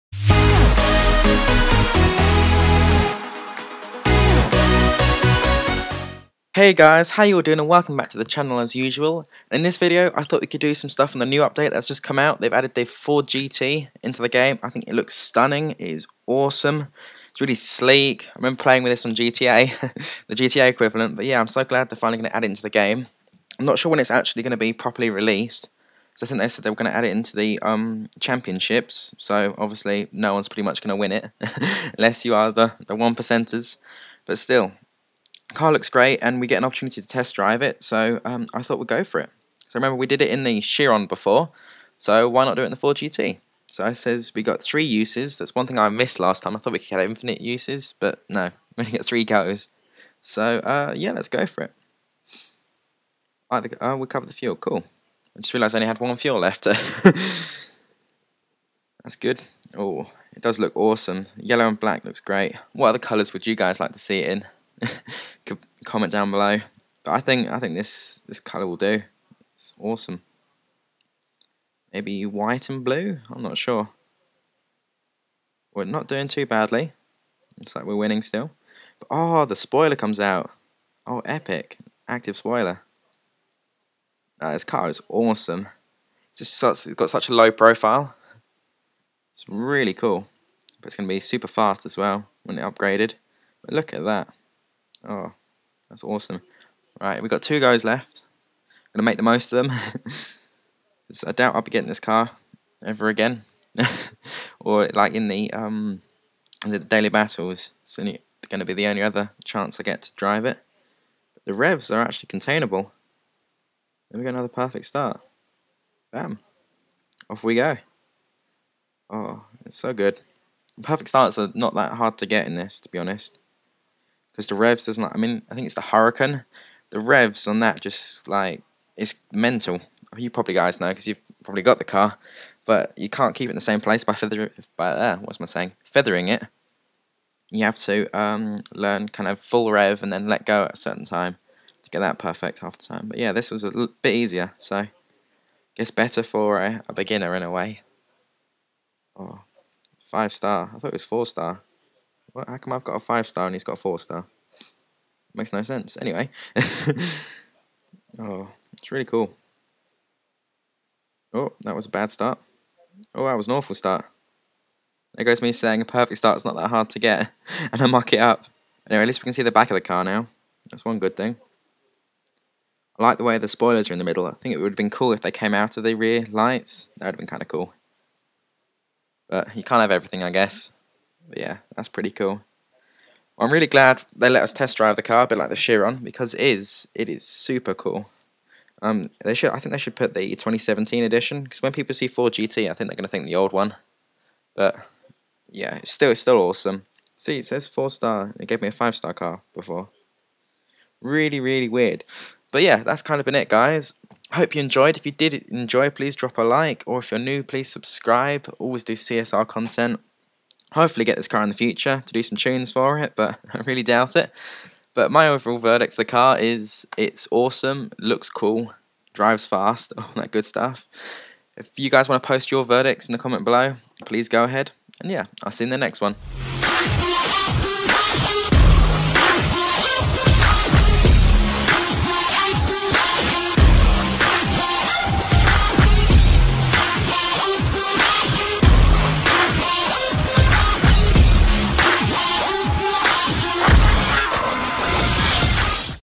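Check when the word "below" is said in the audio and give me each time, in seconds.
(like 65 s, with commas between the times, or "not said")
66 s, 223 s.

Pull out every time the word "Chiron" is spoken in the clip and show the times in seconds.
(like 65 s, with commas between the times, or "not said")
40 s, 185 s.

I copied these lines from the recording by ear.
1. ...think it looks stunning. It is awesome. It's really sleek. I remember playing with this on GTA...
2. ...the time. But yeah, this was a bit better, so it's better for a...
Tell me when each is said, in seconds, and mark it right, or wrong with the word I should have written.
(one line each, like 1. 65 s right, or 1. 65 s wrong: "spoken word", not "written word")
1. 14 s right
2. 142 s wrong: "easier", not "better".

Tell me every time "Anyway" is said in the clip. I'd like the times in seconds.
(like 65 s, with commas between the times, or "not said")
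156 s, 168 s.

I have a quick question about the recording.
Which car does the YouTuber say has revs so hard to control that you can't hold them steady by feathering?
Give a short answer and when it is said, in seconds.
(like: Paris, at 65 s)
Huracan, at 125 s.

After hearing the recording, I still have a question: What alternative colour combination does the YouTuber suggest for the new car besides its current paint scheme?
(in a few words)
White and blue.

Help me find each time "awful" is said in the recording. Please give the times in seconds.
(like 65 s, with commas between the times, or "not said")
163 s.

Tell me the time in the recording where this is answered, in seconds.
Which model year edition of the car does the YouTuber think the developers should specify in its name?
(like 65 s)
190 s.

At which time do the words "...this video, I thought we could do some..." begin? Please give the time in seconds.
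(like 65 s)
9 s.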